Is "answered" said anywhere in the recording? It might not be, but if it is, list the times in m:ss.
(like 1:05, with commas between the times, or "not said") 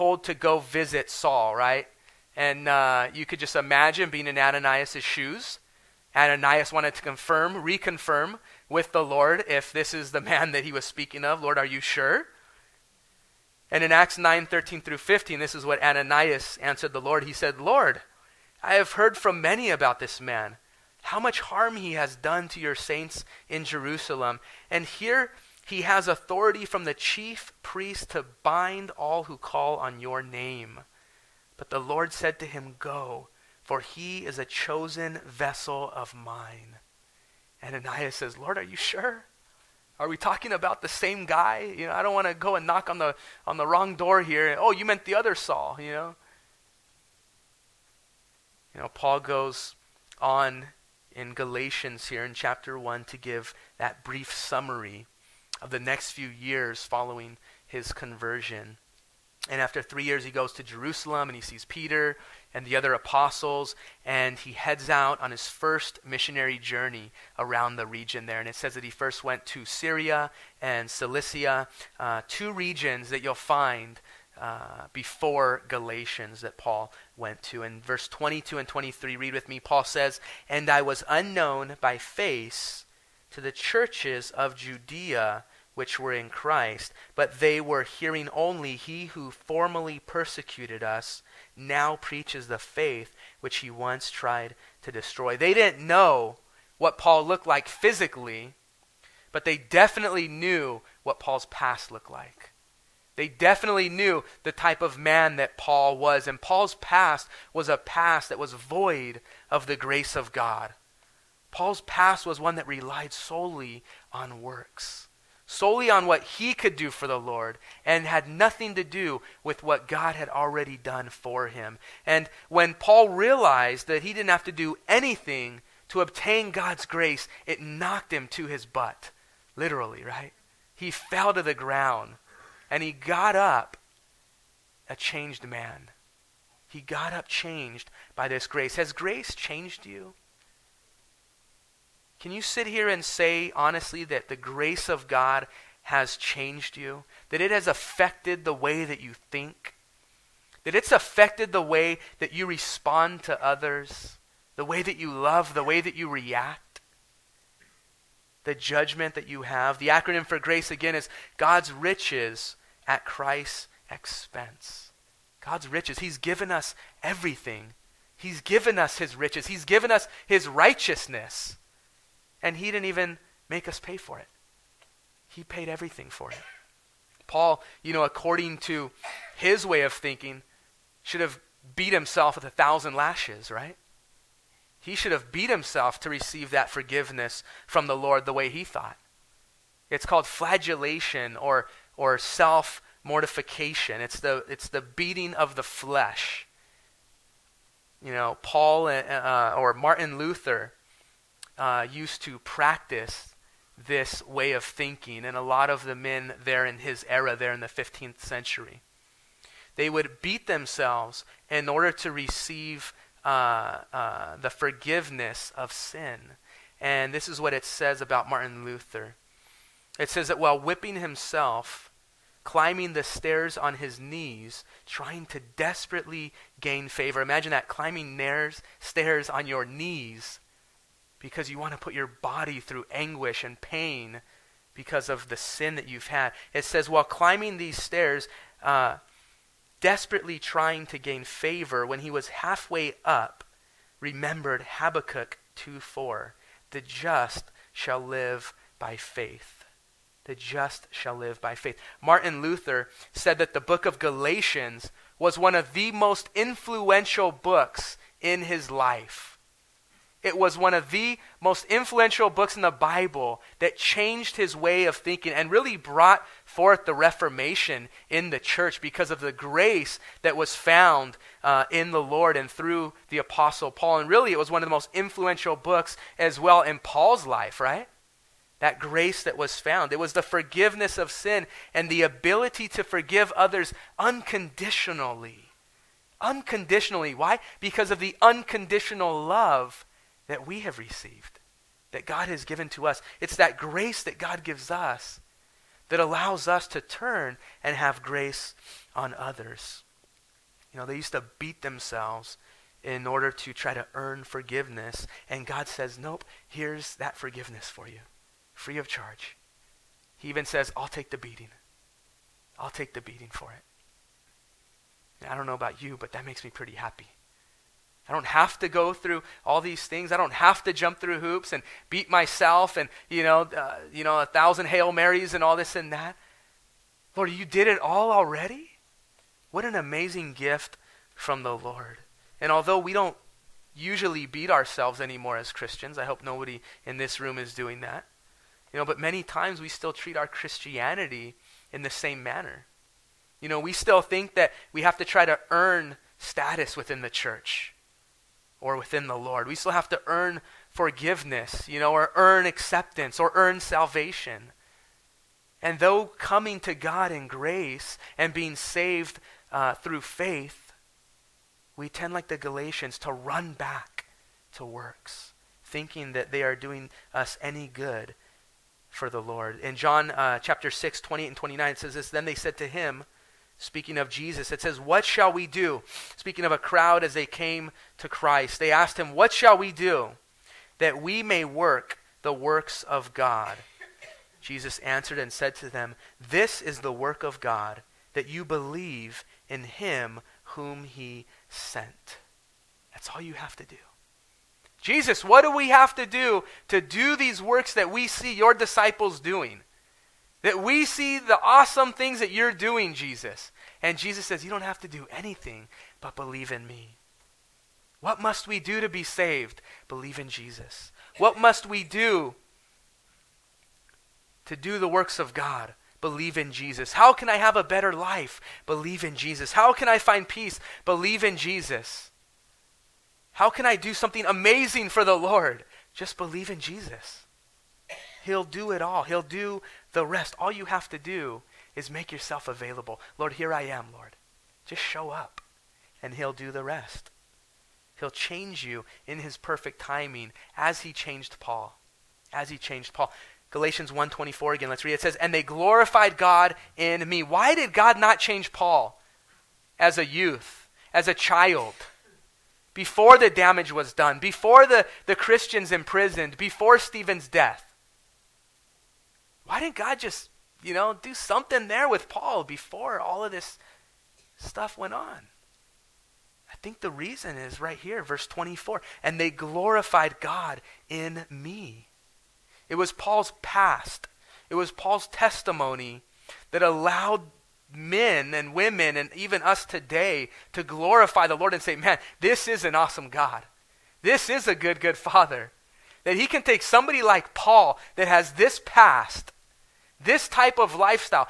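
0:16, 6:24.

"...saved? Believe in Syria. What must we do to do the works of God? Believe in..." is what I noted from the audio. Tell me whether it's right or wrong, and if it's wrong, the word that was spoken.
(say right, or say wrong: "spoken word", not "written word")
wrong: "Jesus", not "Syria".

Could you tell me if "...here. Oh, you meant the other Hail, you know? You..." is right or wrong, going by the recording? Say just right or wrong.
wrong.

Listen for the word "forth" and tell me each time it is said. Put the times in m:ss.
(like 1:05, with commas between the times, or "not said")
4:26.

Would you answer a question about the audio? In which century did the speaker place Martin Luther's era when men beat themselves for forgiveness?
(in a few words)
15th century.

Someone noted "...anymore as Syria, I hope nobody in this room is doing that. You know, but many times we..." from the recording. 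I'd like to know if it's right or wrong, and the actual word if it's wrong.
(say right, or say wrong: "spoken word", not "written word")
wrong: "Christians", not "Syria".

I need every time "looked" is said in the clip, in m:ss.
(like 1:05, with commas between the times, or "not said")
1:37, 1:41.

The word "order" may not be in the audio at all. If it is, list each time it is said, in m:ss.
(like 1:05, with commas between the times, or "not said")
3:31, 5:03.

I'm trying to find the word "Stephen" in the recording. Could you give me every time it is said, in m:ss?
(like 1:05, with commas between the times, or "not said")
7:36.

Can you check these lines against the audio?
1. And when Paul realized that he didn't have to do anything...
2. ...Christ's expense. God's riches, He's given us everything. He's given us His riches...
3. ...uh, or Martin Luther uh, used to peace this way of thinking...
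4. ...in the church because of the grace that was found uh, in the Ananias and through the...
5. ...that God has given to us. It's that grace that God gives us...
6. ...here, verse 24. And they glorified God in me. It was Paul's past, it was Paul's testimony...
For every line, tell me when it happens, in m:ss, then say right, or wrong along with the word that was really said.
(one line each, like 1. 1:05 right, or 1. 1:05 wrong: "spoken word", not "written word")
1. 2:02 right
2. 2:43 right
3. 3:19 wrong: "practice", not "peace"
4. 4:28 wrong: "Lord", not "Ananias"
5. 4:51 right
6. 7:47 right.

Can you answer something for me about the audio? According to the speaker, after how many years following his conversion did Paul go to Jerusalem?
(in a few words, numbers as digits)
3.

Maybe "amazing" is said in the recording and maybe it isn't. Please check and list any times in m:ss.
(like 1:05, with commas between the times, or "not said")
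5:29, 7:04.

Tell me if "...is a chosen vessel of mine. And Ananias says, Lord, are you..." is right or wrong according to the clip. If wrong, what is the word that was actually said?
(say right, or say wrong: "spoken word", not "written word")
right.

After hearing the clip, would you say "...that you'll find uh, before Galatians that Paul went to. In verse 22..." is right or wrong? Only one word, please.
right.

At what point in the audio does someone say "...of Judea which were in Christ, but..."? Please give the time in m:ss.
1:24.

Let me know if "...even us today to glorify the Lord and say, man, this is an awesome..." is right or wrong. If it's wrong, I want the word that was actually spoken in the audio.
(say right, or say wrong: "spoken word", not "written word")
right.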